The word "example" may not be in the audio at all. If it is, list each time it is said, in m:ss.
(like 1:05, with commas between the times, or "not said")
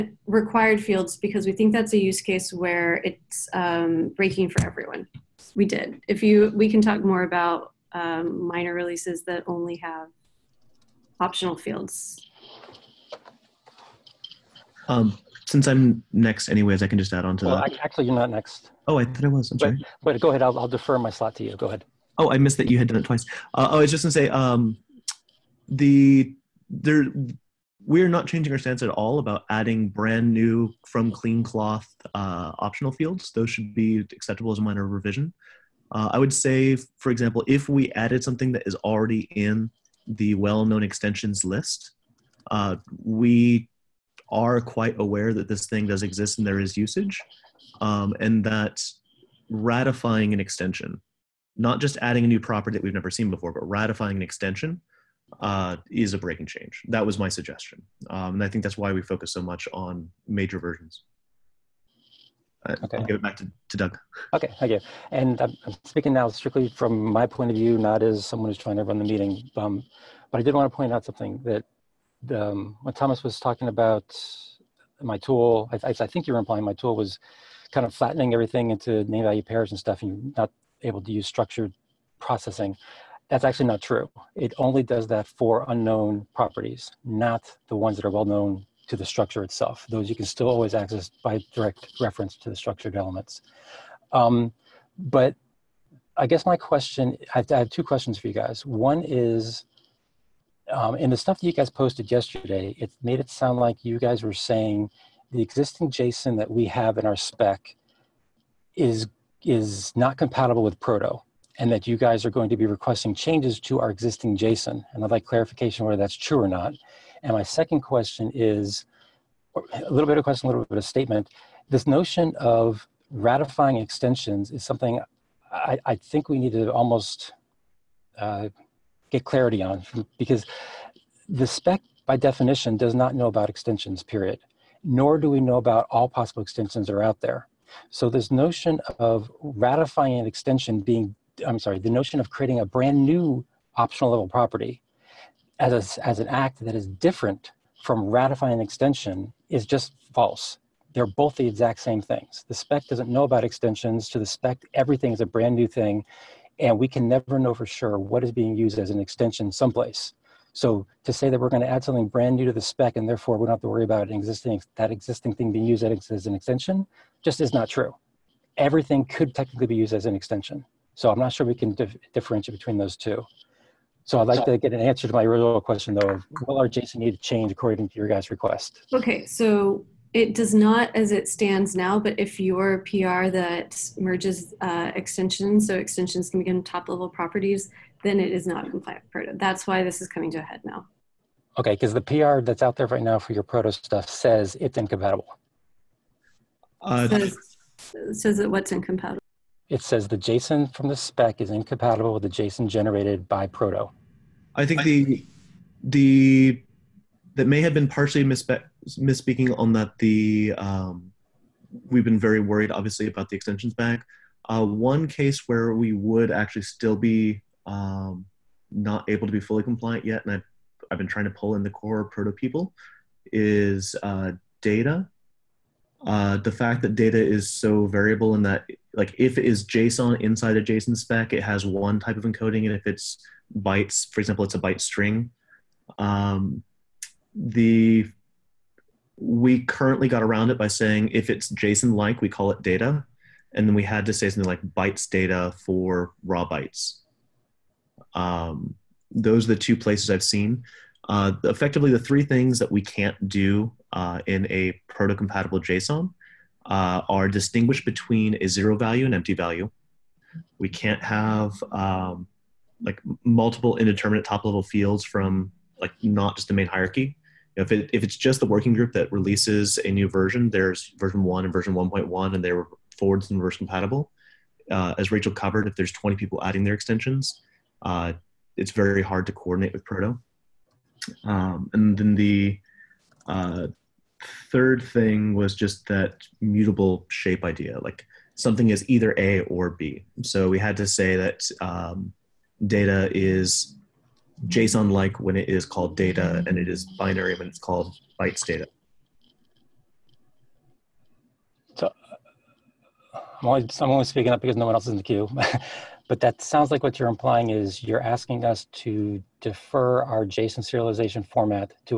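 0:37, 3:54.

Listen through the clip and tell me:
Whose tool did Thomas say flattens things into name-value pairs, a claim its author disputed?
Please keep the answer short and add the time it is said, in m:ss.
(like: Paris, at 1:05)
Doug, at 1:03.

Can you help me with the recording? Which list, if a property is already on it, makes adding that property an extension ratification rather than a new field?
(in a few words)
well-known extensions list.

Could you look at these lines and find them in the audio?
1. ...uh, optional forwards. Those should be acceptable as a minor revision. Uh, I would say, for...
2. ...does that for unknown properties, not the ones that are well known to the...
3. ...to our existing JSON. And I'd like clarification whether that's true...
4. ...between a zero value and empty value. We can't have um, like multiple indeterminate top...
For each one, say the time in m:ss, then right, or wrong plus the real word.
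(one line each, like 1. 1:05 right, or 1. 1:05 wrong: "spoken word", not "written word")
1. 0:32 wrong: "fields", not "forwards"
2. 1:24 right
3. 1:53 right
4. 4:17 right.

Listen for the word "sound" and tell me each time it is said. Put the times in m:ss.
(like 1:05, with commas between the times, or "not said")
1:43, 5:06.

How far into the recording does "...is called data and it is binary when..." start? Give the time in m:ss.
4:55.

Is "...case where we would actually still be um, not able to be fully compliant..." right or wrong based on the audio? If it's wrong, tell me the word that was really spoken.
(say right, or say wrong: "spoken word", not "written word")
right.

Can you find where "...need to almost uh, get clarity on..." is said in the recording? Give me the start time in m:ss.
2:06.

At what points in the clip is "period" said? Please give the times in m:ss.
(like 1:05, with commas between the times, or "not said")
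2:14.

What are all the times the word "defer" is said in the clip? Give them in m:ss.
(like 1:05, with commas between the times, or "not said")
0:20, 5:09.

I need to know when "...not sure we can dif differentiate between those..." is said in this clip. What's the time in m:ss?
2:51.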